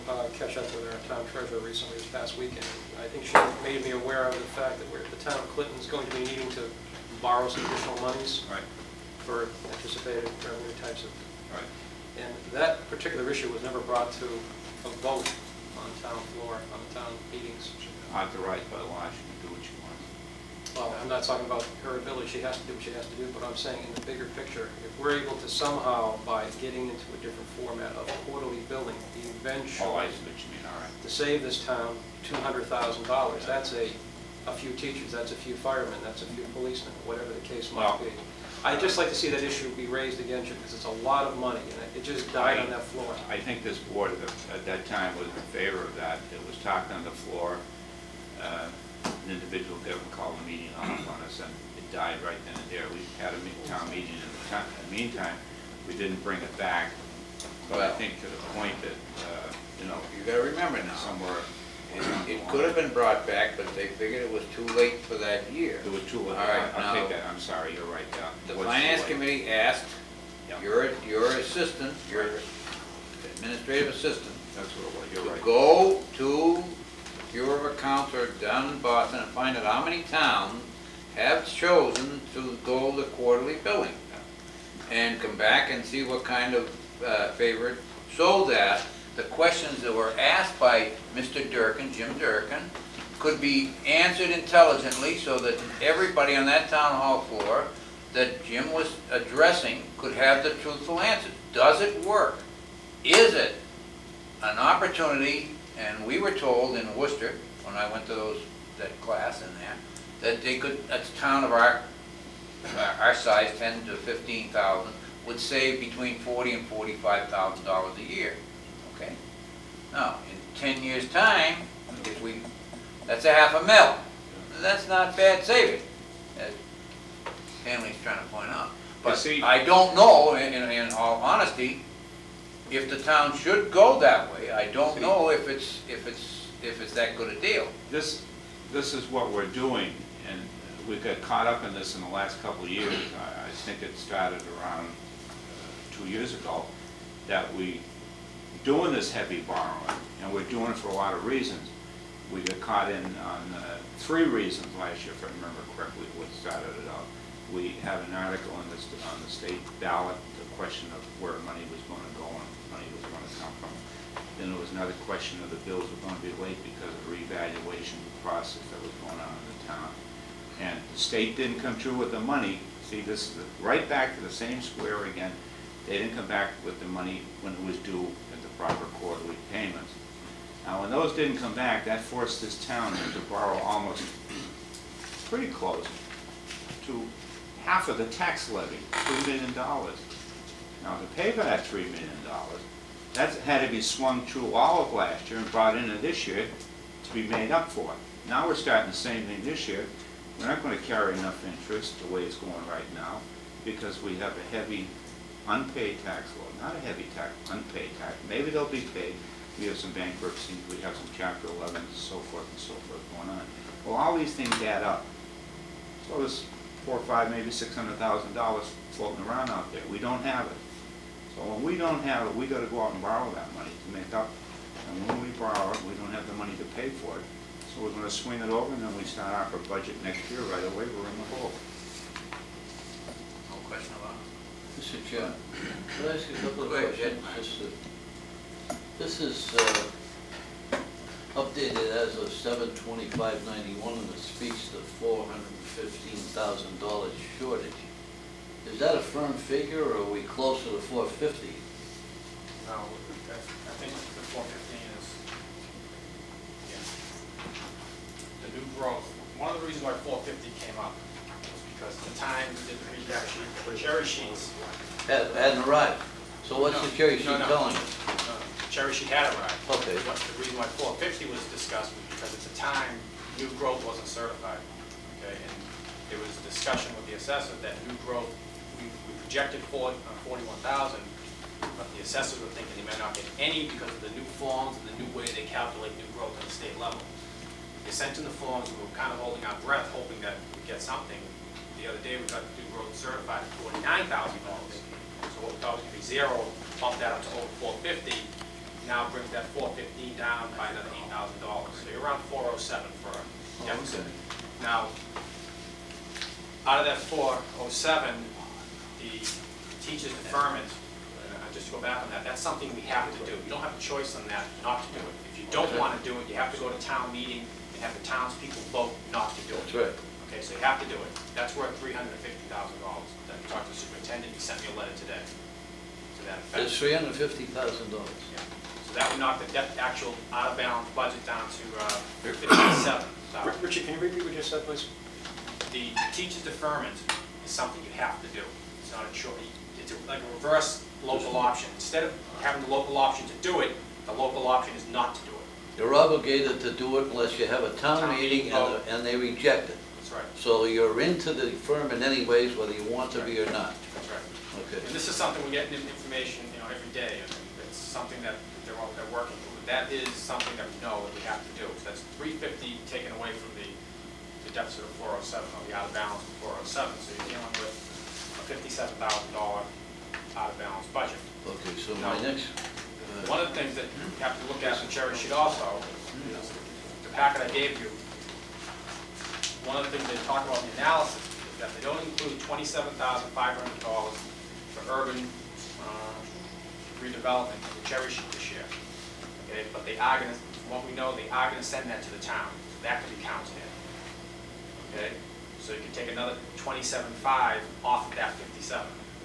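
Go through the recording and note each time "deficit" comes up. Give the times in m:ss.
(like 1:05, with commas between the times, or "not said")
5:03, 6:04.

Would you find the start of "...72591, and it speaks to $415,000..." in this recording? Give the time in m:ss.
4:02.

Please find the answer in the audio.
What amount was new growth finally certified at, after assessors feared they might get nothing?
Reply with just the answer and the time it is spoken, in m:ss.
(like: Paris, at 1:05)
$49,000, at 4:53.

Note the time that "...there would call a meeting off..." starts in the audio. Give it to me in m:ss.
0:49.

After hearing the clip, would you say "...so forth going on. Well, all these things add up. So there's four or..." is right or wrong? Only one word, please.
right.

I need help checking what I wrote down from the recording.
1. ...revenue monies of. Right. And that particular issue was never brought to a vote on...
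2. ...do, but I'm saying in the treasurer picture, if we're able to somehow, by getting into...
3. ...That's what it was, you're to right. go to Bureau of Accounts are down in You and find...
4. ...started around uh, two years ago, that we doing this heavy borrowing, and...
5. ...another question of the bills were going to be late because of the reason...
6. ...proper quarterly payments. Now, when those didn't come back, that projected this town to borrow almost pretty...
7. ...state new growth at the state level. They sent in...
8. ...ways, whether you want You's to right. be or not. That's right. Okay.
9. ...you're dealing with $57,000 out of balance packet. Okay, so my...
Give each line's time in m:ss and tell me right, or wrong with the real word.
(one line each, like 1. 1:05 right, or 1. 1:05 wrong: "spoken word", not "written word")
1. 0:10 wrong: "types", not "monies"
2. 0:23 wrong: "bigger", not "treasurer"
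3. 1:14 wrong: "Boston", not "You"
4. 2:23 right
5. 2:44 wrong: "revaluation", not "reason"
6. 2:58 wrong: "forced", not "projected"
7. 4:45 wrong: "calculate", not "state"
8. 5:52 wrong: "That", not "You"
9. 6:07 wrong: "budget", not "packet".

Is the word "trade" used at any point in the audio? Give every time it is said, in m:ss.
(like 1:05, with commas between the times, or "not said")
not said.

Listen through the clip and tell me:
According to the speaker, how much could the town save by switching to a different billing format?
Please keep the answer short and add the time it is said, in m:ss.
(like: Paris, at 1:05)
$200,000, at 0:32.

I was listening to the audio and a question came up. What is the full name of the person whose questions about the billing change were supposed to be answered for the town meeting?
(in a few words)
Jim Durkin.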